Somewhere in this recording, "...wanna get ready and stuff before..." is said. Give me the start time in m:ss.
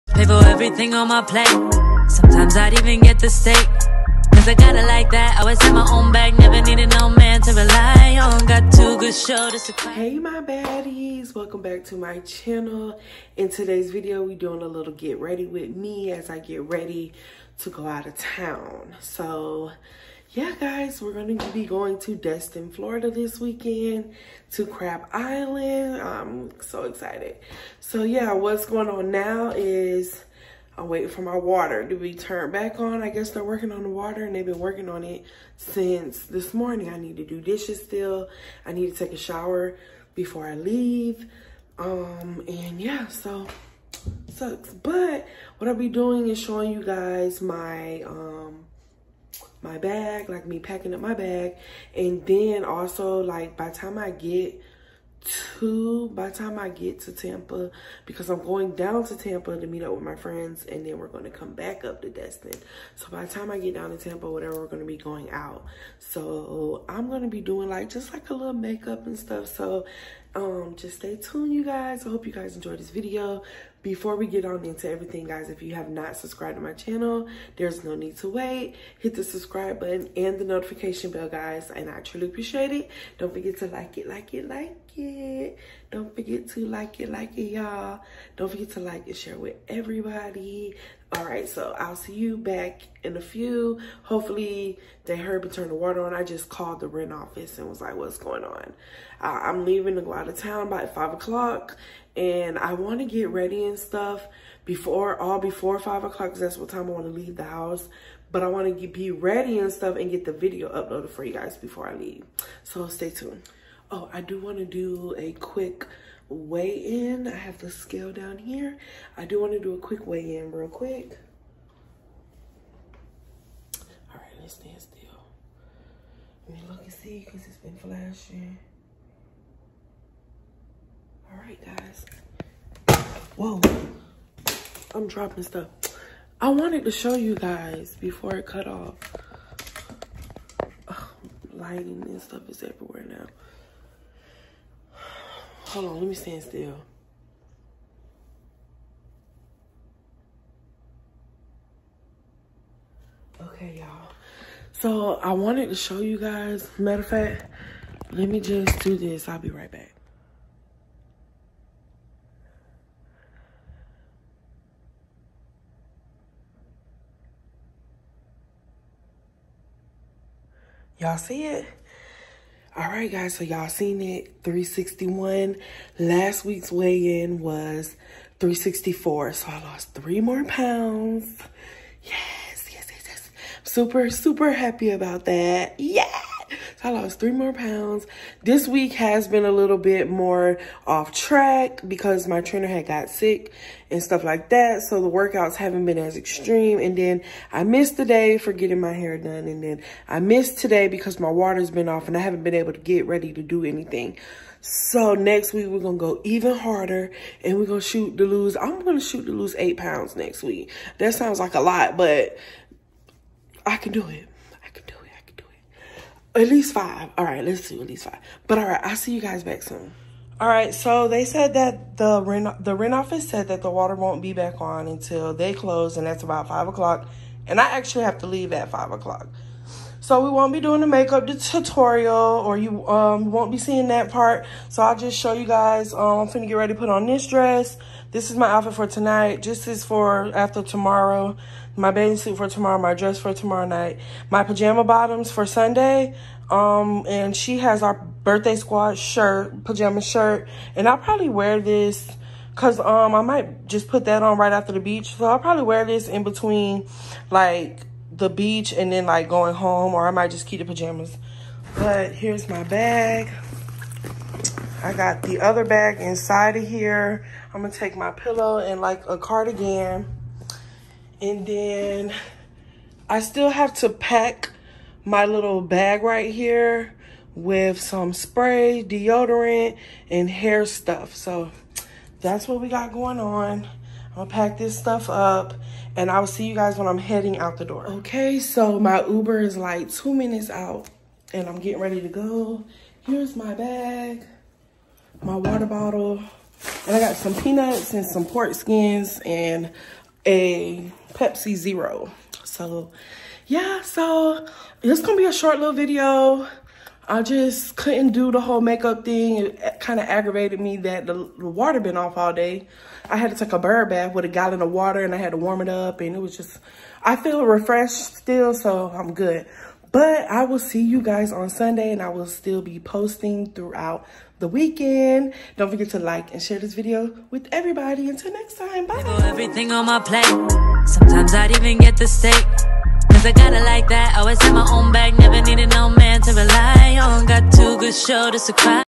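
1:42.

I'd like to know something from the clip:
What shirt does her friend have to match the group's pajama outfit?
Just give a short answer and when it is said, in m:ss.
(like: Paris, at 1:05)
birthday squad shirt, at 4:08.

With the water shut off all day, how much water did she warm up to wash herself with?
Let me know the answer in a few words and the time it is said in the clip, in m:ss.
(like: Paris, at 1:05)
a gallon, at 5:14.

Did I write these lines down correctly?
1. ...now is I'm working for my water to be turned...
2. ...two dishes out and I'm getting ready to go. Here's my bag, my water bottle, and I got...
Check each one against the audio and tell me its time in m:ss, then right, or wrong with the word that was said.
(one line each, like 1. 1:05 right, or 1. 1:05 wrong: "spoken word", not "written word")
1. 0:29 wrong: "waiting", not "working"
2. 4:49 wrong: "minutes", not "dishes".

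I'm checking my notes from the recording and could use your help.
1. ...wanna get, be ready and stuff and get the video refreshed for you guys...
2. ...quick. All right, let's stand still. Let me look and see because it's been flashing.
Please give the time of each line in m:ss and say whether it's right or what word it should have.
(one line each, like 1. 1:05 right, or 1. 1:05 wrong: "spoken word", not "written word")
1. 1:48 wrong: "uploaded", not "refreshed"
2. 2:00 right.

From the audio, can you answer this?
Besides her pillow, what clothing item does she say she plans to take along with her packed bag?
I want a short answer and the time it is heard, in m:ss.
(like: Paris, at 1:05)
a cardigan, at 4:29.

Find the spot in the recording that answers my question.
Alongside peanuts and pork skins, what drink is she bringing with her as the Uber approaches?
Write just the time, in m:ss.
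5:01.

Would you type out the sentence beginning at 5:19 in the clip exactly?
But I will see you guys on Sunday and I will still be posting throughout the weekend.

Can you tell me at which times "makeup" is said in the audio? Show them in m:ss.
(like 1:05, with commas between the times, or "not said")
1:08, 3:50, 5:08.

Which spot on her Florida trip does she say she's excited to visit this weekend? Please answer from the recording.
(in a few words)
Crab Island.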